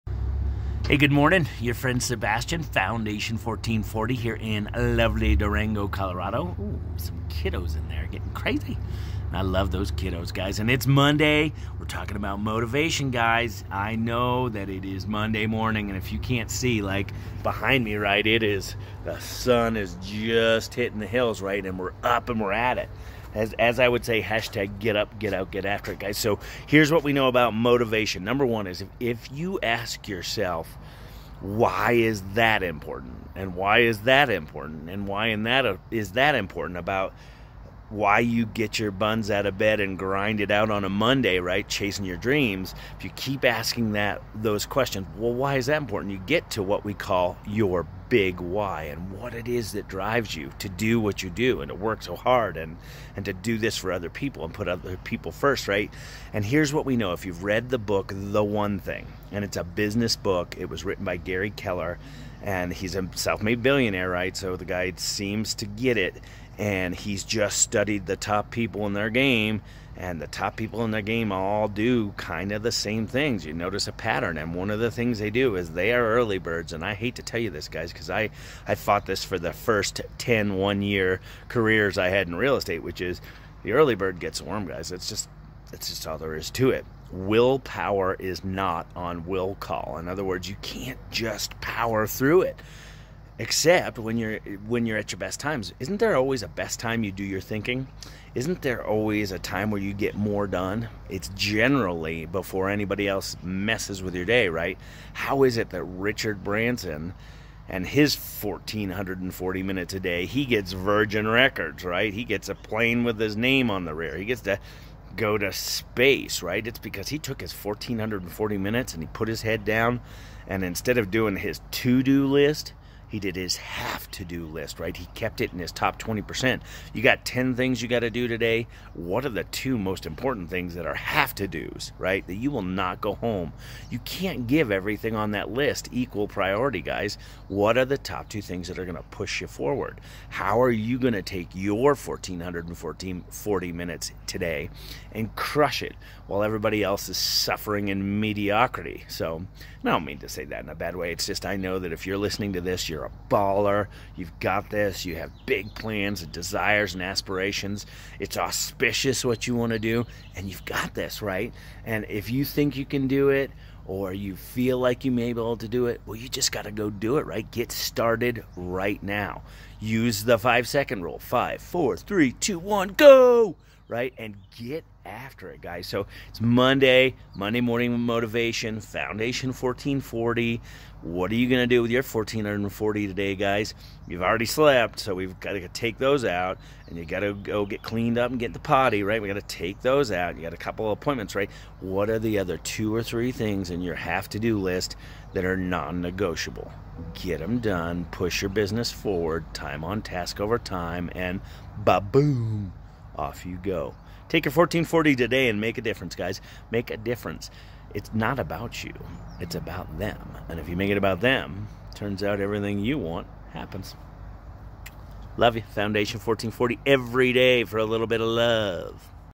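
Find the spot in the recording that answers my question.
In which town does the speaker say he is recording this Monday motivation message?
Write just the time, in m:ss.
0:05.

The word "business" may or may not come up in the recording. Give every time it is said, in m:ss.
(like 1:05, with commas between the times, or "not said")
0:59, 3:18.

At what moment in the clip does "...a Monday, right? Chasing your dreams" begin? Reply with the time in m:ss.
0:40.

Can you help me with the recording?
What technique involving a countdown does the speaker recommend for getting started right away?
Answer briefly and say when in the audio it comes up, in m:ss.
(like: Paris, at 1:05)
five second rule, at 2:50.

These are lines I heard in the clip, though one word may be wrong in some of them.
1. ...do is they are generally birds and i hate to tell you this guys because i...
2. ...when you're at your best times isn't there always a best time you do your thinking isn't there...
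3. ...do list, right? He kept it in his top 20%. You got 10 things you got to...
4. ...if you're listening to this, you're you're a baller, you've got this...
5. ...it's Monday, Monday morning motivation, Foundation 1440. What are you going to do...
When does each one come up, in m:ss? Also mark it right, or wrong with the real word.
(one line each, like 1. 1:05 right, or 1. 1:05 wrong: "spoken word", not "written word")
1. 1:15 wrong: "early", not "generally"
2. 1:34 right
3. 2:04 right
4. 2:31 right
5. 2:56 right.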